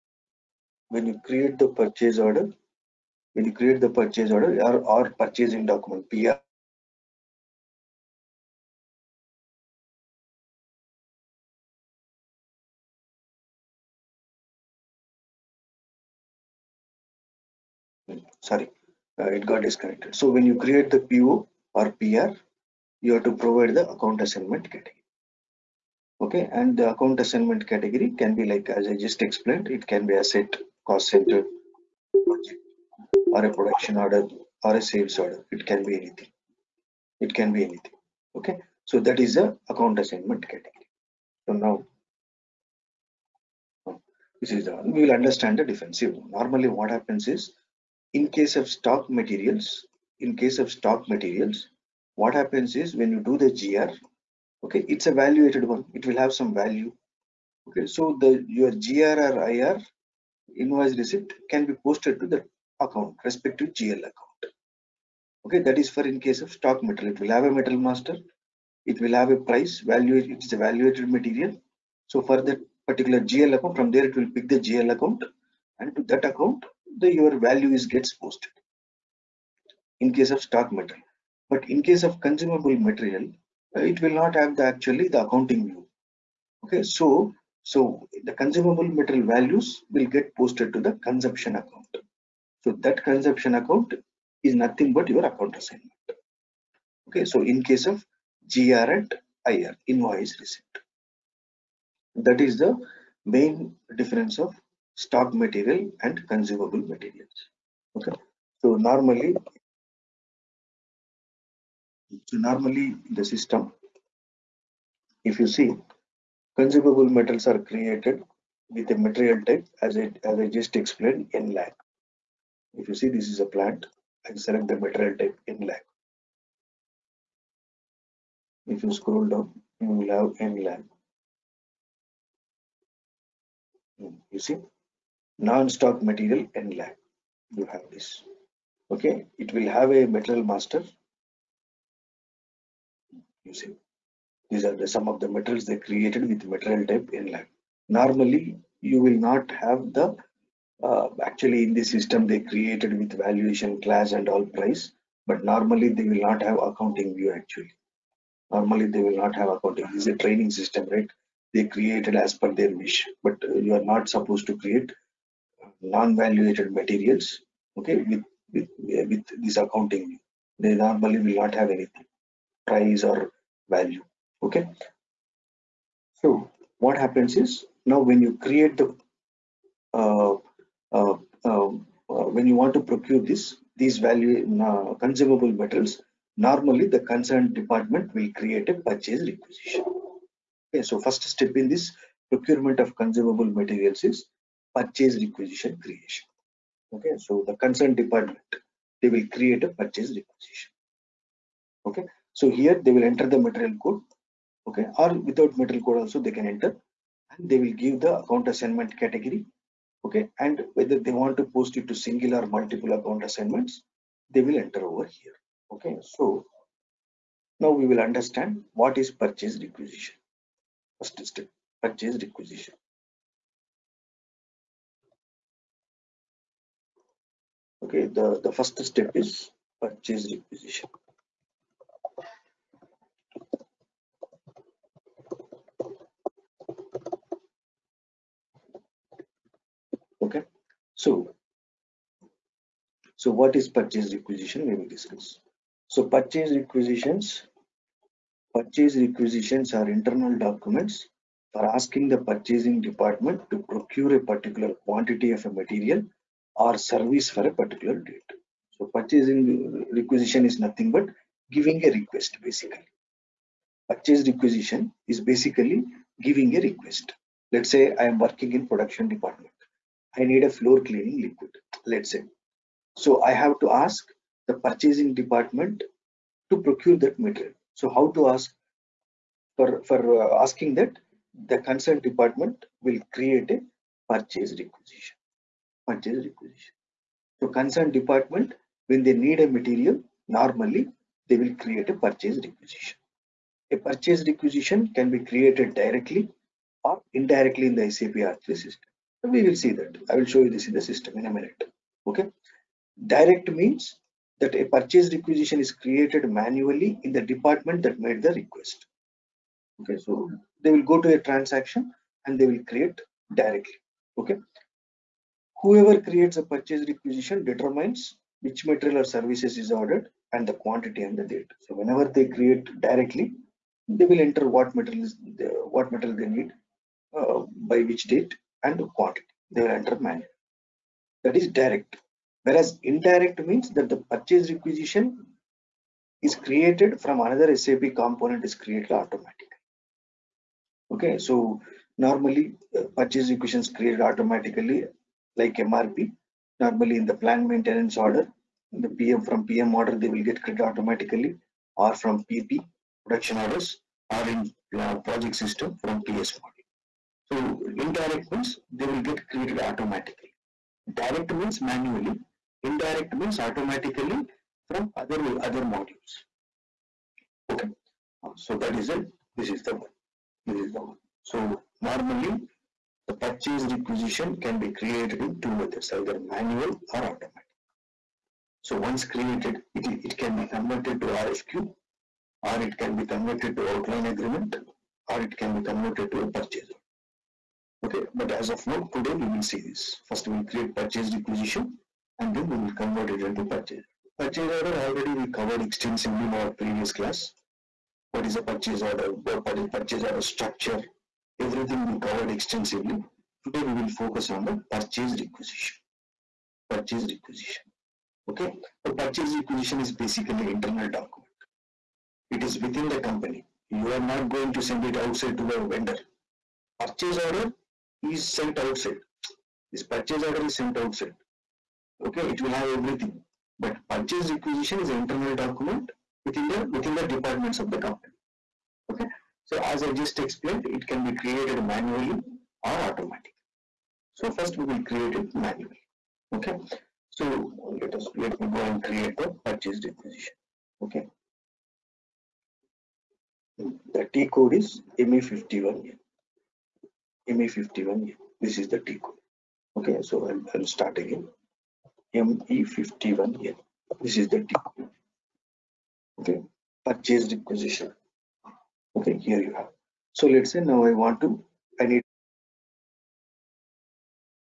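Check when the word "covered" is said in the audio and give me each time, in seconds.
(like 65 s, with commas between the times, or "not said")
395 s, 401 s.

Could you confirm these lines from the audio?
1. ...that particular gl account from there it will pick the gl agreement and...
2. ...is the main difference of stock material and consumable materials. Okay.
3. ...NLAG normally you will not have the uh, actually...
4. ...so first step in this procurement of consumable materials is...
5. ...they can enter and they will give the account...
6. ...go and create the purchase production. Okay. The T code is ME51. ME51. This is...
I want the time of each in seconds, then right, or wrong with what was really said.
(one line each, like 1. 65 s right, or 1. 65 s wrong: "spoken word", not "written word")
1. 72 s wrong: "account", not "agreement"
2. 102 s right
3. 147 s right
4. 190 s right
5. 206 s right
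6. 438 s wrong: "requisition", not "production".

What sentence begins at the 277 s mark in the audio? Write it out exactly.
So how to ask for, for uh, asking that the concerned department will create a purchase requisition purchase requisition.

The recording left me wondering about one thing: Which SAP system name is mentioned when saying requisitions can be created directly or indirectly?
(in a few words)
SAP R3.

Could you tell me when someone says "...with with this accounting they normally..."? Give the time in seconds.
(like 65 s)
168 s.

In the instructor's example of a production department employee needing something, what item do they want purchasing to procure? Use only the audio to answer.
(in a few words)
Floor cleaning liquid.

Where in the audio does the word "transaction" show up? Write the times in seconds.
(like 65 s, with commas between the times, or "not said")
311 s.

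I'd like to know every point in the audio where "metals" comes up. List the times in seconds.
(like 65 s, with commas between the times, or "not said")
117 s, 145 s, 185 s.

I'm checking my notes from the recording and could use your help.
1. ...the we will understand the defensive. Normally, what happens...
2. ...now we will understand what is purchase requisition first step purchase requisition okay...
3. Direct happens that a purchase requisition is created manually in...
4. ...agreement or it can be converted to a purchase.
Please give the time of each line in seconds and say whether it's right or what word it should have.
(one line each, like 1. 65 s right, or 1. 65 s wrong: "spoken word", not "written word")
1. 44 s right
2. 217 s right
3. 303 s wrong: "means", not "happens"
4. 384 s right.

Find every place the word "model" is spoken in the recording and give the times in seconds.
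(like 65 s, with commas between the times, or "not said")
356 s.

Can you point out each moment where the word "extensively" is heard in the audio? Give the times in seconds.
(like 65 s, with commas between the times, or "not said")
395 s, 402 s.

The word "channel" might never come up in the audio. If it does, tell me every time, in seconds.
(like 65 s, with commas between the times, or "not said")
not said.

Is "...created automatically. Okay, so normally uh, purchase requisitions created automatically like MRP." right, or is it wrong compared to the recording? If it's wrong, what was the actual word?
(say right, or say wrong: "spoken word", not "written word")
right.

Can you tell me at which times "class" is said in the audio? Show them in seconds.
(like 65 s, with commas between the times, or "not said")
153 s, 396 s.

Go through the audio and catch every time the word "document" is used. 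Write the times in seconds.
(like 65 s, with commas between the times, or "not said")
5 s, 250 s, 410 s, 425 s.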